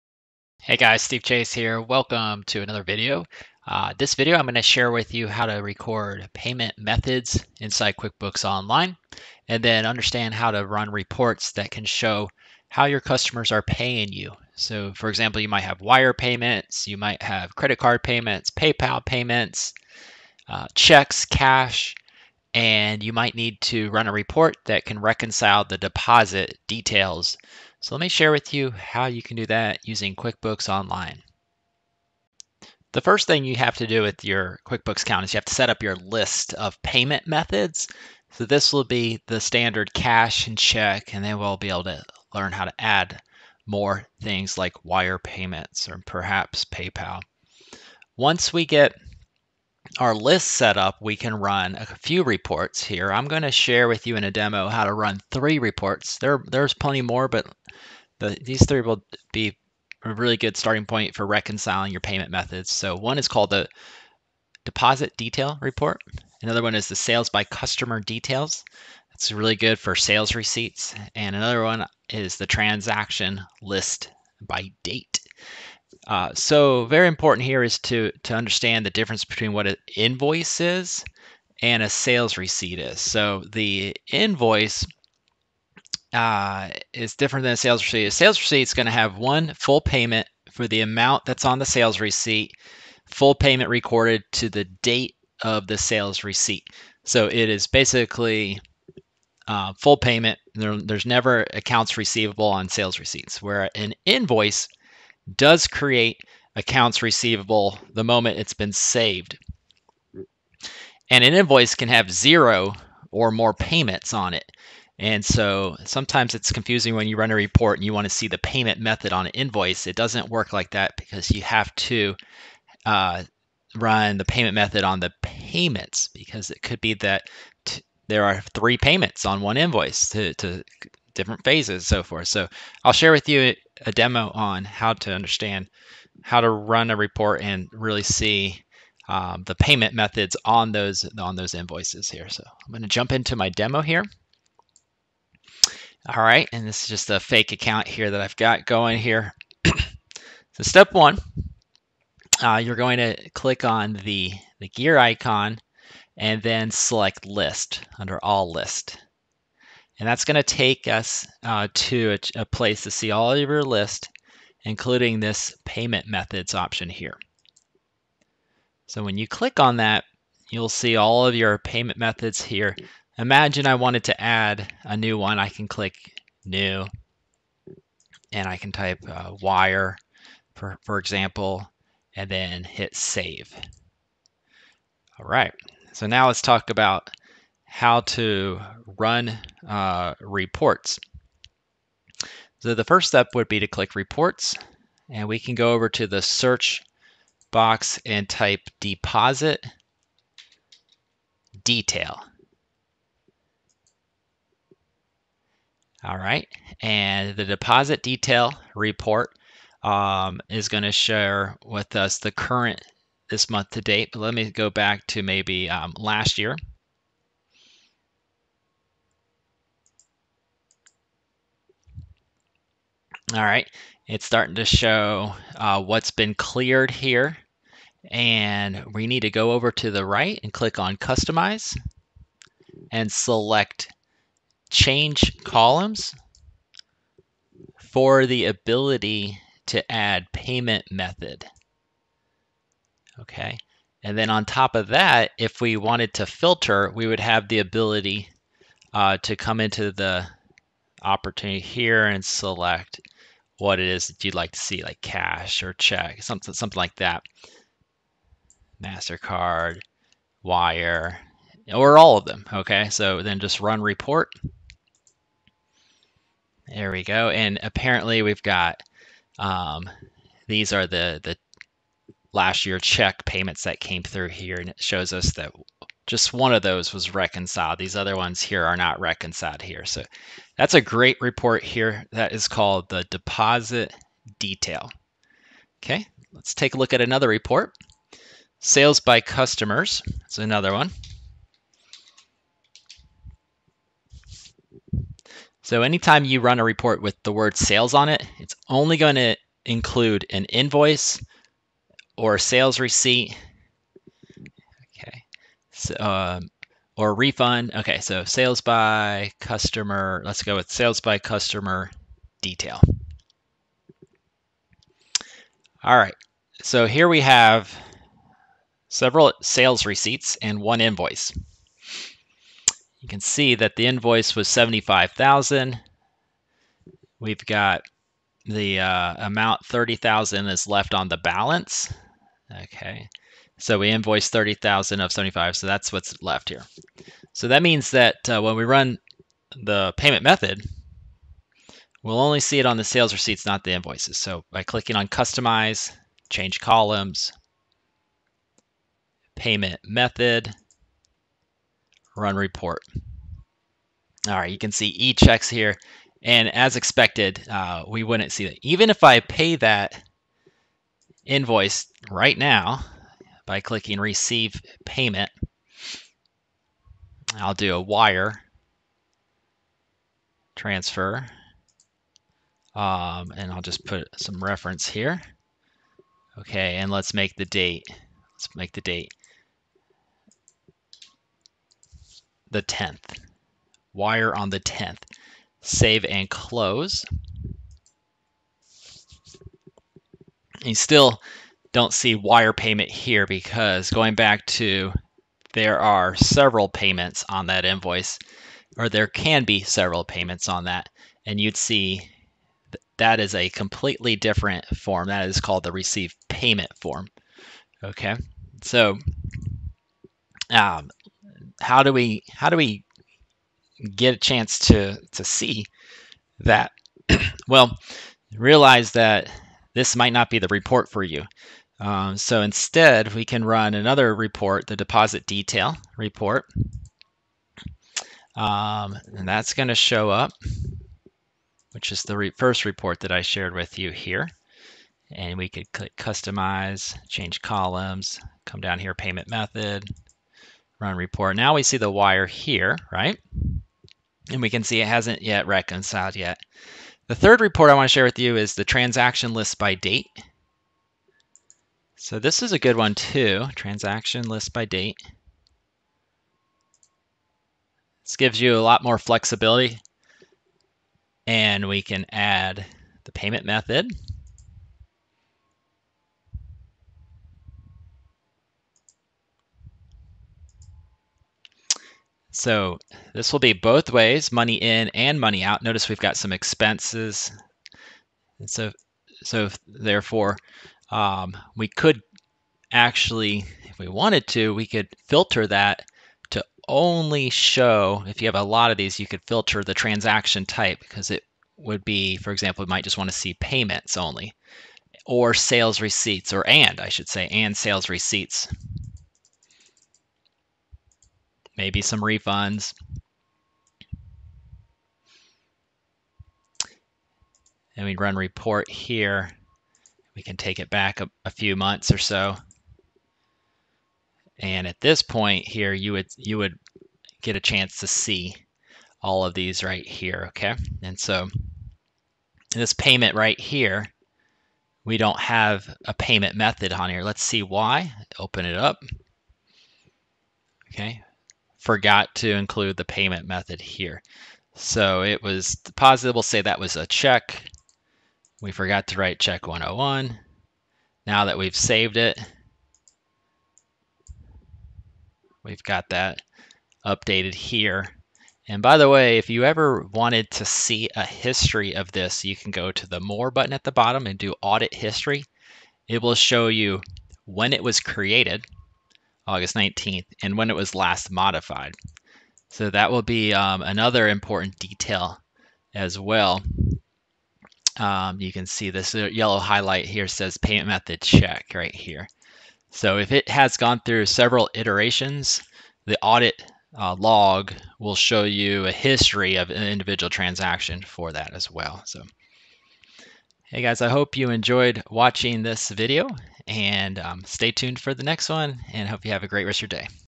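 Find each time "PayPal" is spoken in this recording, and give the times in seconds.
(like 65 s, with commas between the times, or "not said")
18 s, 46 s.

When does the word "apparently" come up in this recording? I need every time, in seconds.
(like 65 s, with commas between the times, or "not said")
267 s.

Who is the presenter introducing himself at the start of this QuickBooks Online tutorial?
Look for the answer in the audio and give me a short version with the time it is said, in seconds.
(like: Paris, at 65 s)
Steve Chase, at 1 s.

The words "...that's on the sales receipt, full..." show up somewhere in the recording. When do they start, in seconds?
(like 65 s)
91 s.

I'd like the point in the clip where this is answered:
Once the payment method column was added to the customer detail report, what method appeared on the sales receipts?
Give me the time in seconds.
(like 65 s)
354 s.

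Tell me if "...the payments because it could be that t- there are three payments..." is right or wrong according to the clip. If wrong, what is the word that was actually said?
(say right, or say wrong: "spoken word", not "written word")
right.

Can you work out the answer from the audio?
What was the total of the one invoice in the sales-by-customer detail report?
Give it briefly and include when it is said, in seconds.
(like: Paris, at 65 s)
75,000, at 324 s.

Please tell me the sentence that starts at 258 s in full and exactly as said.
MasterCard, Wire, or all of them.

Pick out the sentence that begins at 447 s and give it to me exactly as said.
The third report I want to share with you is the transaction list by date.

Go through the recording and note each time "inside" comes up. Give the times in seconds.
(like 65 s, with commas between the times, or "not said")
7 s.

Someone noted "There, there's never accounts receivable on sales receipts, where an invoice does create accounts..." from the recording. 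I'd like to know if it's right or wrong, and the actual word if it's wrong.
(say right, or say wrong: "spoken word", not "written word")
right.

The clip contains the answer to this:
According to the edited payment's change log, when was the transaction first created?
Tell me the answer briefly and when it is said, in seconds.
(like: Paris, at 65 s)
August 19th, at 559 s.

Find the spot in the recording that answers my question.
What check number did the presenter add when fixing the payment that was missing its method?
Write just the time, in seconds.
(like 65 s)
539 s.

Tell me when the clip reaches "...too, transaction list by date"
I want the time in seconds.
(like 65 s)
452 s.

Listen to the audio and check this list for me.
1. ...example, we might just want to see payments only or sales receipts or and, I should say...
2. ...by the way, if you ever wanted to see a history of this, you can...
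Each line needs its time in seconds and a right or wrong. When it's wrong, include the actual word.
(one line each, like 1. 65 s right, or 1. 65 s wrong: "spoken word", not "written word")
1. 492 s right
2. 548 s right.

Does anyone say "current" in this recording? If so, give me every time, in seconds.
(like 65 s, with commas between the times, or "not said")
212 s.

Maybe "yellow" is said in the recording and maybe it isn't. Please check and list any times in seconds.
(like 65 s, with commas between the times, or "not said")
568 s.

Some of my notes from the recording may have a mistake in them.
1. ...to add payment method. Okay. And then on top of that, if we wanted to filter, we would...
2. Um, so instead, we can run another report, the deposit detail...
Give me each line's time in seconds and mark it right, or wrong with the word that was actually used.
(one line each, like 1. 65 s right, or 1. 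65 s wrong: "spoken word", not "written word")
1. 239 s right
2. 421 s right.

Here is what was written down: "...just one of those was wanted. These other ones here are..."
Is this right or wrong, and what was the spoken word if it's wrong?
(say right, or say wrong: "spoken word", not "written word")
wrong: "reconciled", not "wanted".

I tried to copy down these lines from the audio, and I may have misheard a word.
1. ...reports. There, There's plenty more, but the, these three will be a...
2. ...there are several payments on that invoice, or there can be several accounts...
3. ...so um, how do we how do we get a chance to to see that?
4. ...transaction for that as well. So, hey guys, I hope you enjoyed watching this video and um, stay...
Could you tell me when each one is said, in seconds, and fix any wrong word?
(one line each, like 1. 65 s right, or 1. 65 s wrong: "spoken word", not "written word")
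1. 55 s right
2. 395 s wrong: "payments", not "accounts"
3. 408 s right
4. 580 s right.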